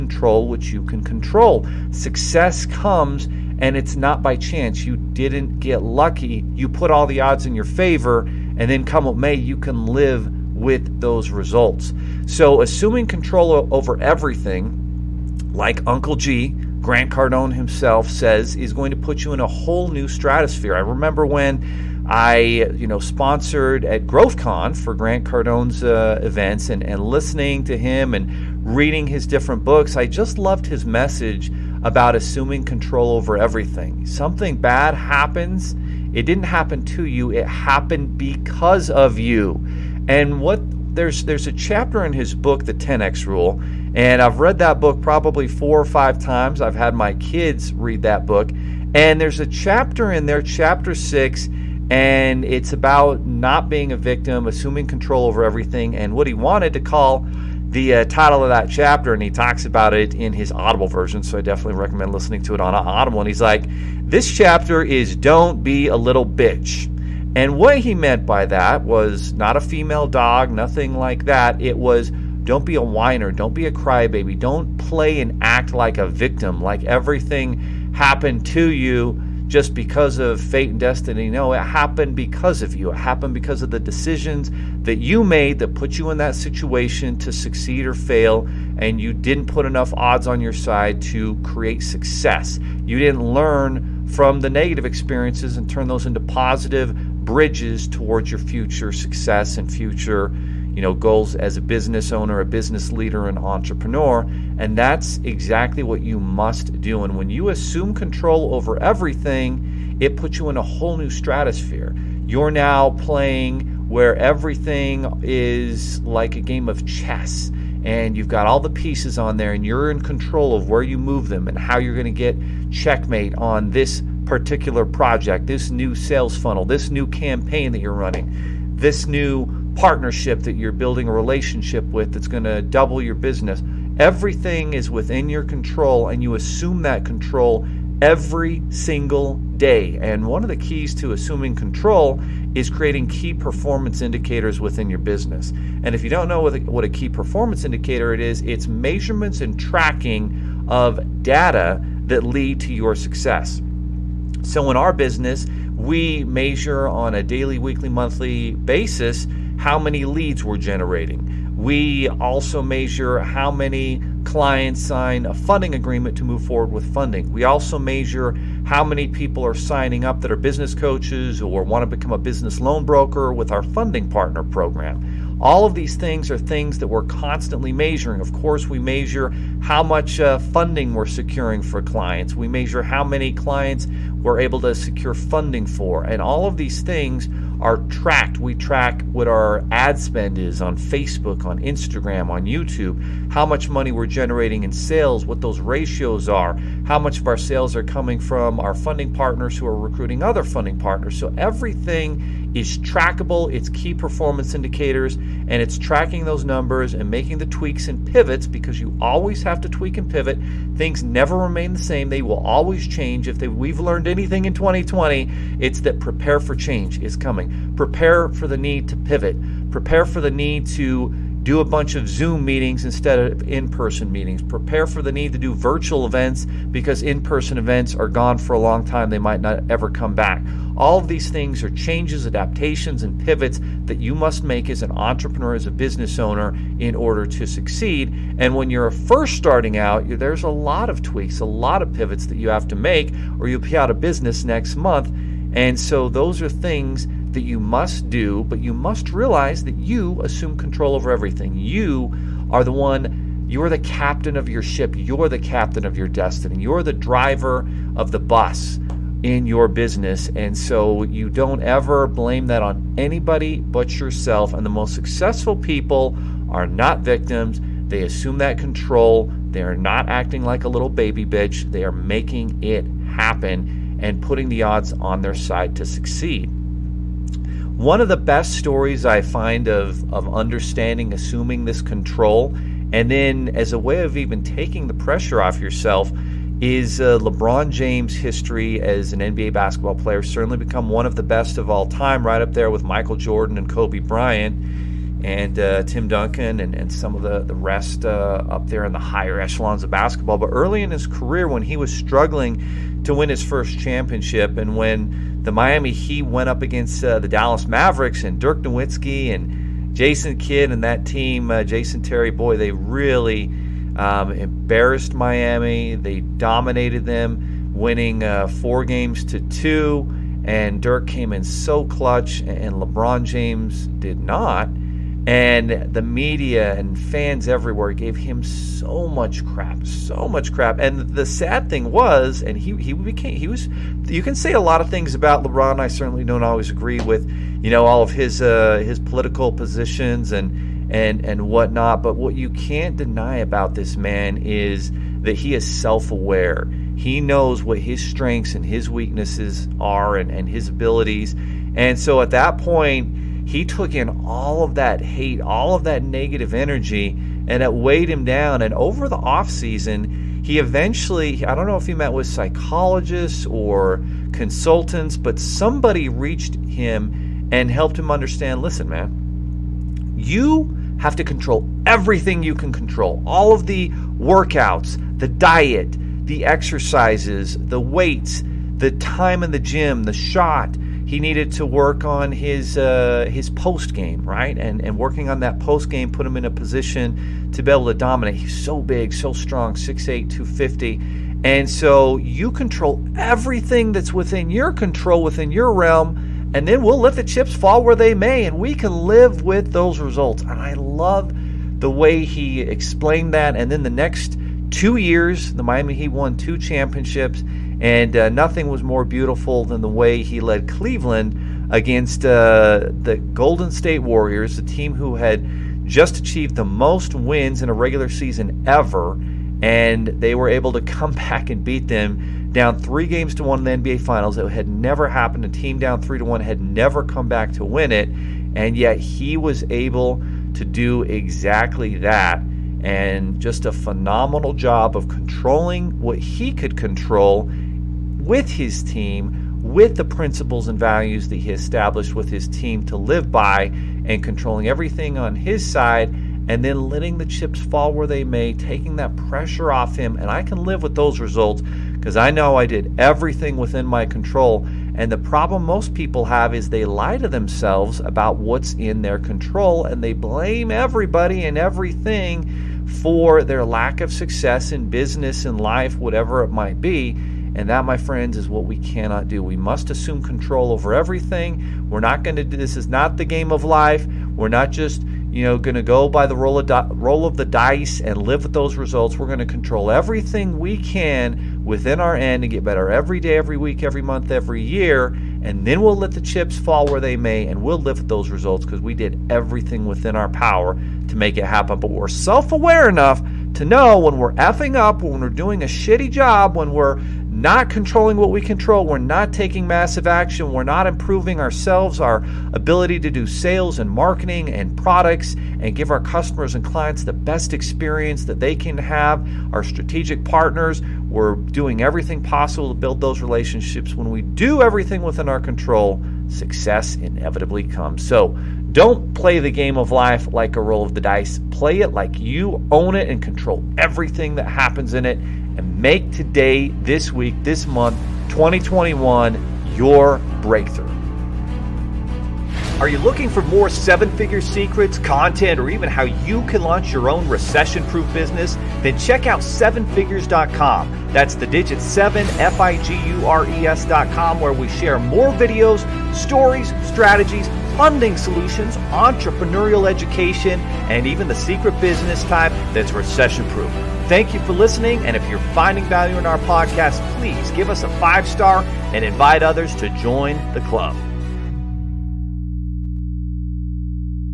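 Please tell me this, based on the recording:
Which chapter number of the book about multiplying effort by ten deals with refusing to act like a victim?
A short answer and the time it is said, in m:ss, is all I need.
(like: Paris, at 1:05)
6, at 0:50.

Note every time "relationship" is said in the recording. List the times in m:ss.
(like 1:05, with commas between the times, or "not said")
2:11, 8:33.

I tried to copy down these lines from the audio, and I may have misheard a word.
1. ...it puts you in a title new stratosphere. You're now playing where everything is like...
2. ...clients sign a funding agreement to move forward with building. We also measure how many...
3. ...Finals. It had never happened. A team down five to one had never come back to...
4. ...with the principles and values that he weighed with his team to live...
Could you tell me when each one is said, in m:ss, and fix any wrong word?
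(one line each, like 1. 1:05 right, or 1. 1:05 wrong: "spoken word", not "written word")
1. 1:49 wrong: "whole", not "title"
2. 2:44 wrong: "funding", not "building"
3. 7:04 wrong: "three", not "five"
4. 7:19 wrong: "established", not "weighed".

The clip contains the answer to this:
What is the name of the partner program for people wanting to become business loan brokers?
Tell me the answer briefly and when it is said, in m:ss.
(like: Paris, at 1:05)
funding partner program, at 2:53.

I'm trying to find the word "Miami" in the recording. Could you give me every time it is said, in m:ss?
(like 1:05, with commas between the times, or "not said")
5:05, 5:15, 6:45.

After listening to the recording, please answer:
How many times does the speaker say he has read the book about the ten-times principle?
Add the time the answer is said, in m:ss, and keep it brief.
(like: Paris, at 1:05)
4 or 5, at 0:45.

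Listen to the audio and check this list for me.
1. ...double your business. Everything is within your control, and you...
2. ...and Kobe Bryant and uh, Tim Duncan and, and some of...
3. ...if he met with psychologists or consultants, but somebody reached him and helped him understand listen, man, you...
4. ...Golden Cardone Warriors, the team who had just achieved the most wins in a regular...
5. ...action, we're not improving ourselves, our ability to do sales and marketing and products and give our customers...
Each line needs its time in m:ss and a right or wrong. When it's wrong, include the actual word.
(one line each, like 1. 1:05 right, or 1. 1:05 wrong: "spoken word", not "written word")
1. 2:12 right
2. 4:53 right
3. 6:01 right
4. 6:53 wrong: "State", not "Cardone"
5. 8:20 right.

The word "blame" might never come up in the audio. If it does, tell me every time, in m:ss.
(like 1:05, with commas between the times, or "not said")
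4:22, 7:40.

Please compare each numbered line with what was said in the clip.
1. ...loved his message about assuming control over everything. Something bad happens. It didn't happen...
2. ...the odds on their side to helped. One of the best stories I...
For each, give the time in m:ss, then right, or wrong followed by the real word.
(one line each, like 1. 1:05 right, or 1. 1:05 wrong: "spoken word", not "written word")
1. 0:30 right
2. 4:34 wrong: "succeed", not "helped".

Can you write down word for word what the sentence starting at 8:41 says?
Play it like you own it and control everything that happens in it.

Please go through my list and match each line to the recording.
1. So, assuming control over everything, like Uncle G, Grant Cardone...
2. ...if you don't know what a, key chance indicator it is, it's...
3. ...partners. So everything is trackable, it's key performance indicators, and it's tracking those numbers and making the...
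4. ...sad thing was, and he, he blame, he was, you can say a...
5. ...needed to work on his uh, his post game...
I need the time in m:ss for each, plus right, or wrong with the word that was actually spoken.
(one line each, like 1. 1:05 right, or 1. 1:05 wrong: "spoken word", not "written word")
1. 0:12 right
2. 2:25 wrong: "performance", not "chance"
3. 3:20 right
4. 5:31 wrong: "became", not "blame"
5. 6:21 right.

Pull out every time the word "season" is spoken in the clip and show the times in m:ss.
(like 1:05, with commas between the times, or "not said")
5:59, 6:58.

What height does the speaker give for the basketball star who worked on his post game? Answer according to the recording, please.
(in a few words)
6'8".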